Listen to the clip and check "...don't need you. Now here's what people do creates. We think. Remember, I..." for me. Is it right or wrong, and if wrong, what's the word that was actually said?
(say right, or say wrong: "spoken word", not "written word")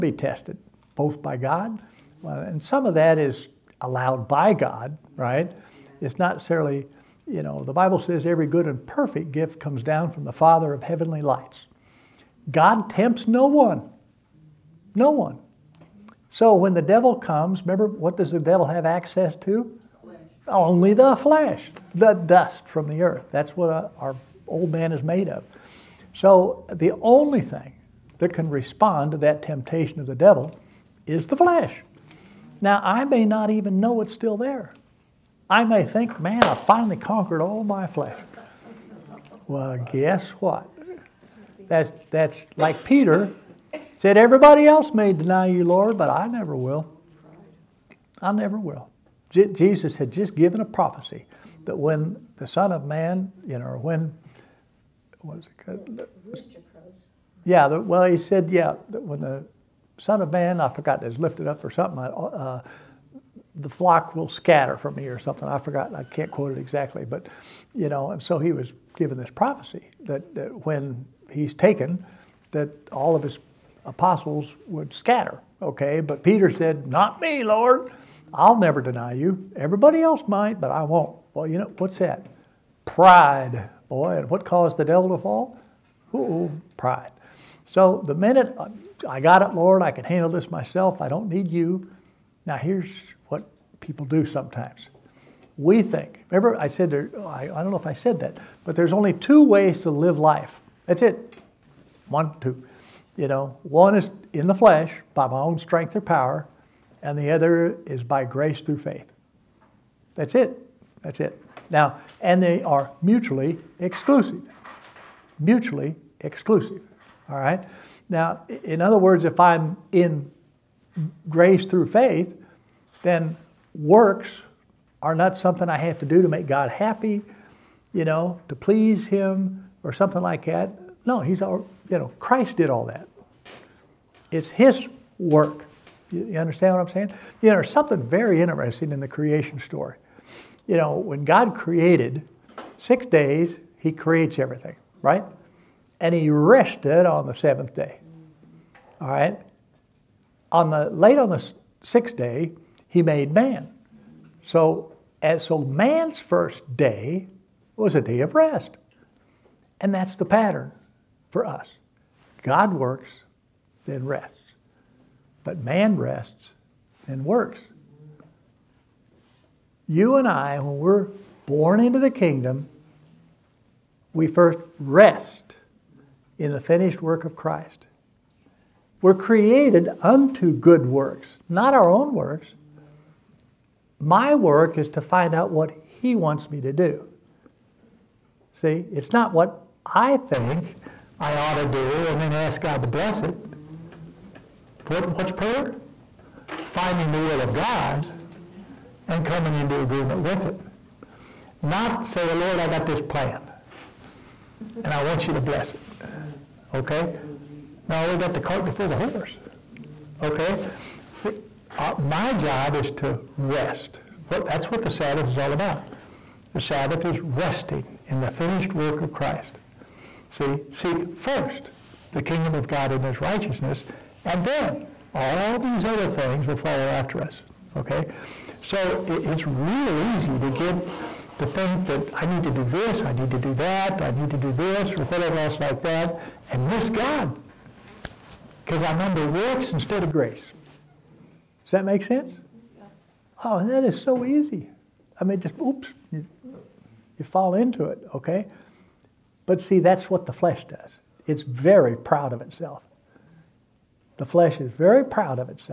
wrong: "sometimes", not "creates".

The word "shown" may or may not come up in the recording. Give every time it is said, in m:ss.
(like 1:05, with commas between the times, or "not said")
not said.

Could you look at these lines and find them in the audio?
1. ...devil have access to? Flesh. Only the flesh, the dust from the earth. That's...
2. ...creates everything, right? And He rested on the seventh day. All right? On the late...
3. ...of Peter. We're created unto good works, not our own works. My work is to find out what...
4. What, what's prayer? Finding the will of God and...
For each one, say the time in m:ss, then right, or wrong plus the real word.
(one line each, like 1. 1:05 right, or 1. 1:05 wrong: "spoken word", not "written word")
1. 0:18 right
2. 2:23 right
3. 2:57 wrong: "Christ", not "Peter"
4. 3:14 right.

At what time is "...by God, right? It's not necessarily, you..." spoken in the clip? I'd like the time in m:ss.
0:04.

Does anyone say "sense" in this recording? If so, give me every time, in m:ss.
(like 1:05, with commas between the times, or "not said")
4:02.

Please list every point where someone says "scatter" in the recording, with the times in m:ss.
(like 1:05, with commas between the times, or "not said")
1:04, 1:14.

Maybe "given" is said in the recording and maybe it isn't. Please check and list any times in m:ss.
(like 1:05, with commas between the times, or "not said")
0:50, 1:08.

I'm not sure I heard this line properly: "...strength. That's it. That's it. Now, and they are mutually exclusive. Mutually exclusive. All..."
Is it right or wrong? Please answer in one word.
wrong.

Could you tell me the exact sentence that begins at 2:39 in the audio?
And that's the pattern for us.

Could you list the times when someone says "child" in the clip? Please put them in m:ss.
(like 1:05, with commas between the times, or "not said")
not said.